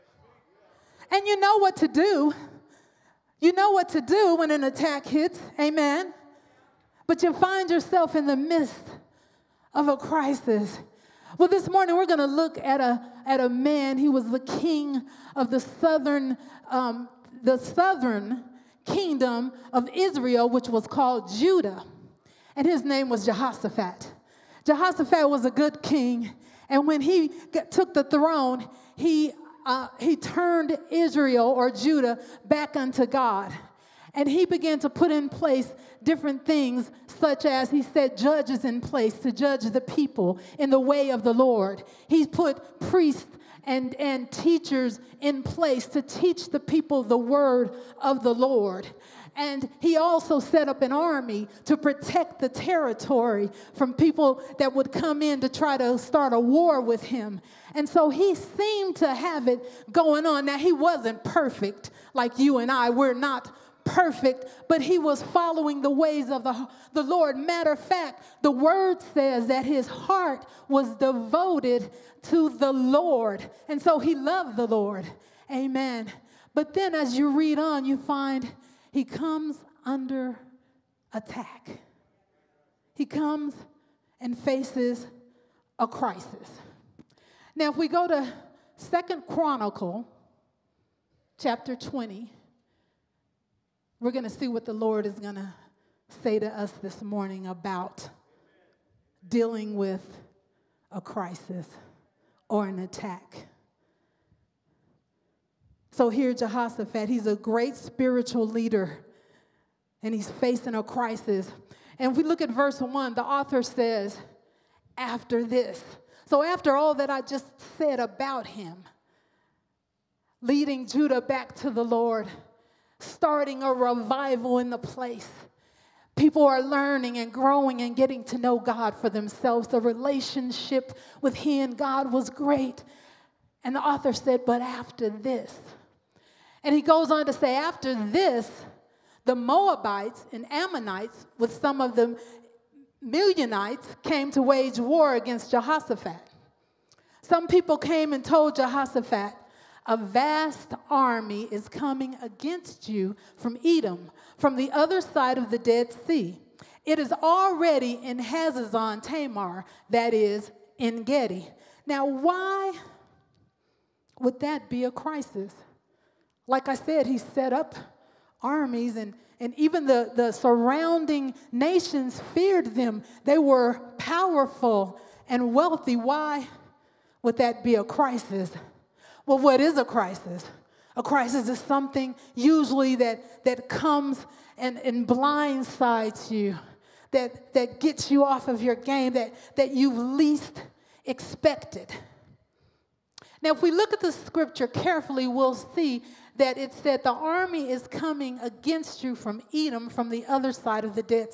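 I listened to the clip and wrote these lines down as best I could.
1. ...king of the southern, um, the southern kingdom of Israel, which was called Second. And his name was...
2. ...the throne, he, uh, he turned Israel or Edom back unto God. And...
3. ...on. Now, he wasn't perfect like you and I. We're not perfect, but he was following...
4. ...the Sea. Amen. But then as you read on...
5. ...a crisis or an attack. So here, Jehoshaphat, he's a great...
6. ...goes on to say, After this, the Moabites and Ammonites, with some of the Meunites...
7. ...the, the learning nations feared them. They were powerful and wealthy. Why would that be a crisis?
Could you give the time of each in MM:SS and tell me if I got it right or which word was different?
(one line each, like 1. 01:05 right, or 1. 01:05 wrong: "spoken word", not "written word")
1. 00:14 wrong: "Judah", not "Second"
2. 00:27 wrong: "Judah", not "Edom"
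3. 01:00 right
4. 01:14 wrong: "Lord", not "Sea"
5. 01:40 right
6. 02:16 right
7. 02:49 wrong: "surrounding", not "learning".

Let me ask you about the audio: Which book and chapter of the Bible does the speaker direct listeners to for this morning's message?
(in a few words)
Second Chronicles 20.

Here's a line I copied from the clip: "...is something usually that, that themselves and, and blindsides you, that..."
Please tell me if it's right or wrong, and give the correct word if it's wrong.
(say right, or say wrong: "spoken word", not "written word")
wrong: "comes", not "themselves".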